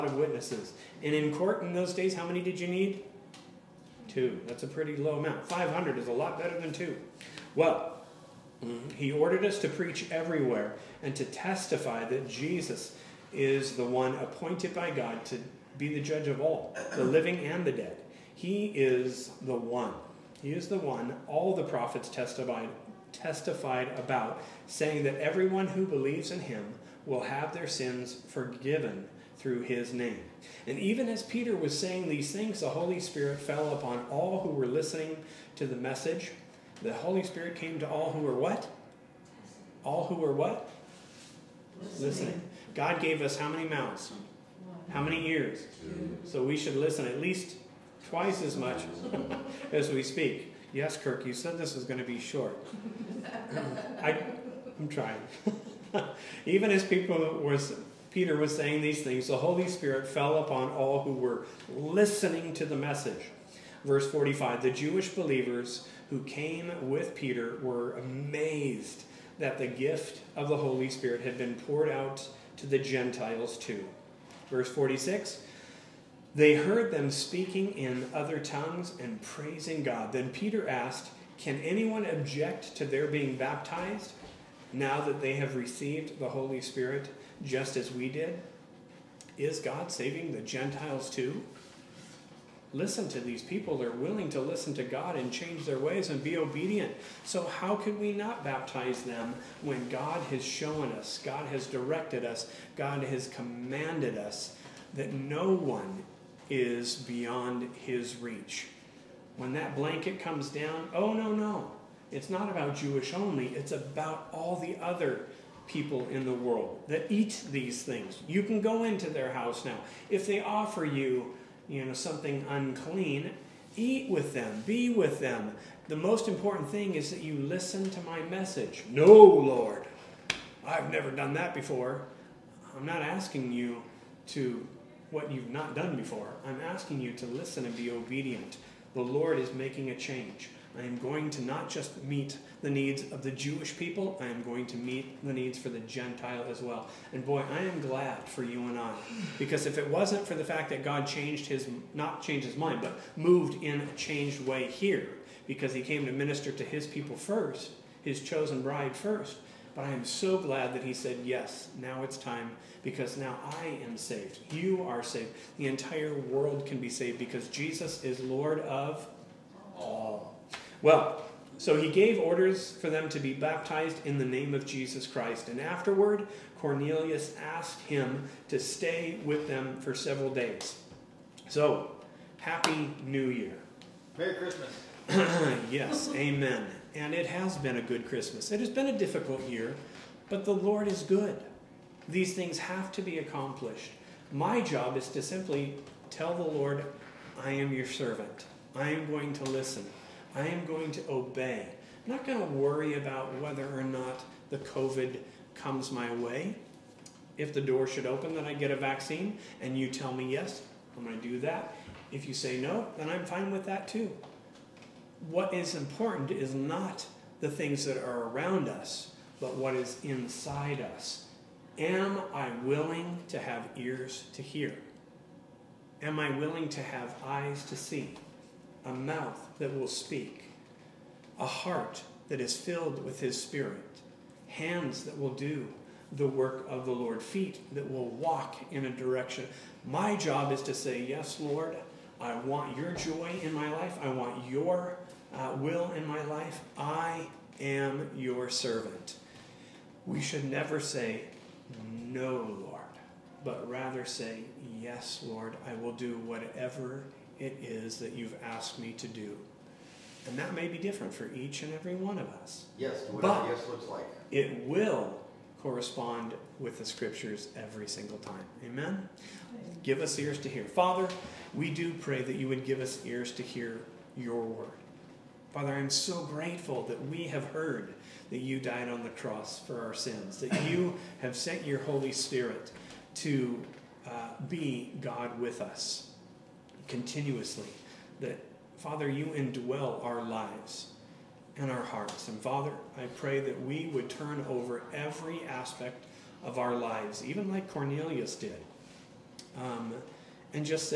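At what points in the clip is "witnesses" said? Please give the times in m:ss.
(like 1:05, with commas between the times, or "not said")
0:00.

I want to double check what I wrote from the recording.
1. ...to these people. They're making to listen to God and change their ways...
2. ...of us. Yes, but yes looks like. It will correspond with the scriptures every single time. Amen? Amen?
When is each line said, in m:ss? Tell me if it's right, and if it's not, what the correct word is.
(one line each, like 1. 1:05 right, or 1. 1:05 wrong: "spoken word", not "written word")
1. 1:33 wrong: "willing", not "making"
2. 4:22 right.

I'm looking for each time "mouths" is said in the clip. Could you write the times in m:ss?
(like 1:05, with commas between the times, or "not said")
0:43, 3:48.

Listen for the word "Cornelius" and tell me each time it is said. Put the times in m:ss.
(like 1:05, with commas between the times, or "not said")
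2:56, 4:57.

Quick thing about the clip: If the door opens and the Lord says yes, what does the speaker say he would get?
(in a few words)
A vaccine.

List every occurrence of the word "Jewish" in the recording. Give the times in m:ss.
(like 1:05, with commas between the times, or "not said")
1:04, 1:52, 2:23.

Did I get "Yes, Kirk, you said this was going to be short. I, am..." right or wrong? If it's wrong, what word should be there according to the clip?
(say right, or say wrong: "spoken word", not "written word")
right.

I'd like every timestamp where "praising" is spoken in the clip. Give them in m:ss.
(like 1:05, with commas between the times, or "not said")
1:19.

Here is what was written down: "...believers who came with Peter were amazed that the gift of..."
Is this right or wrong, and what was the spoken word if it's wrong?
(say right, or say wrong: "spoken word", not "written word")
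right.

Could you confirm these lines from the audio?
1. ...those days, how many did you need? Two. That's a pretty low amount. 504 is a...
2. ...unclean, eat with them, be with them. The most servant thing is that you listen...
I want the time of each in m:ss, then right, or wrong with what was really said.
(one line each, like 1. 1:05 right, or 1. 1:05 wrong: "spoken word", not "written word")
1. 0:01 wrong: "500", not "504"
2. 2:02 wrong: "important", not "servant".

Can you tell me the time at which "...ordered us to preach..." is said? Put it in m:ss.
0:09.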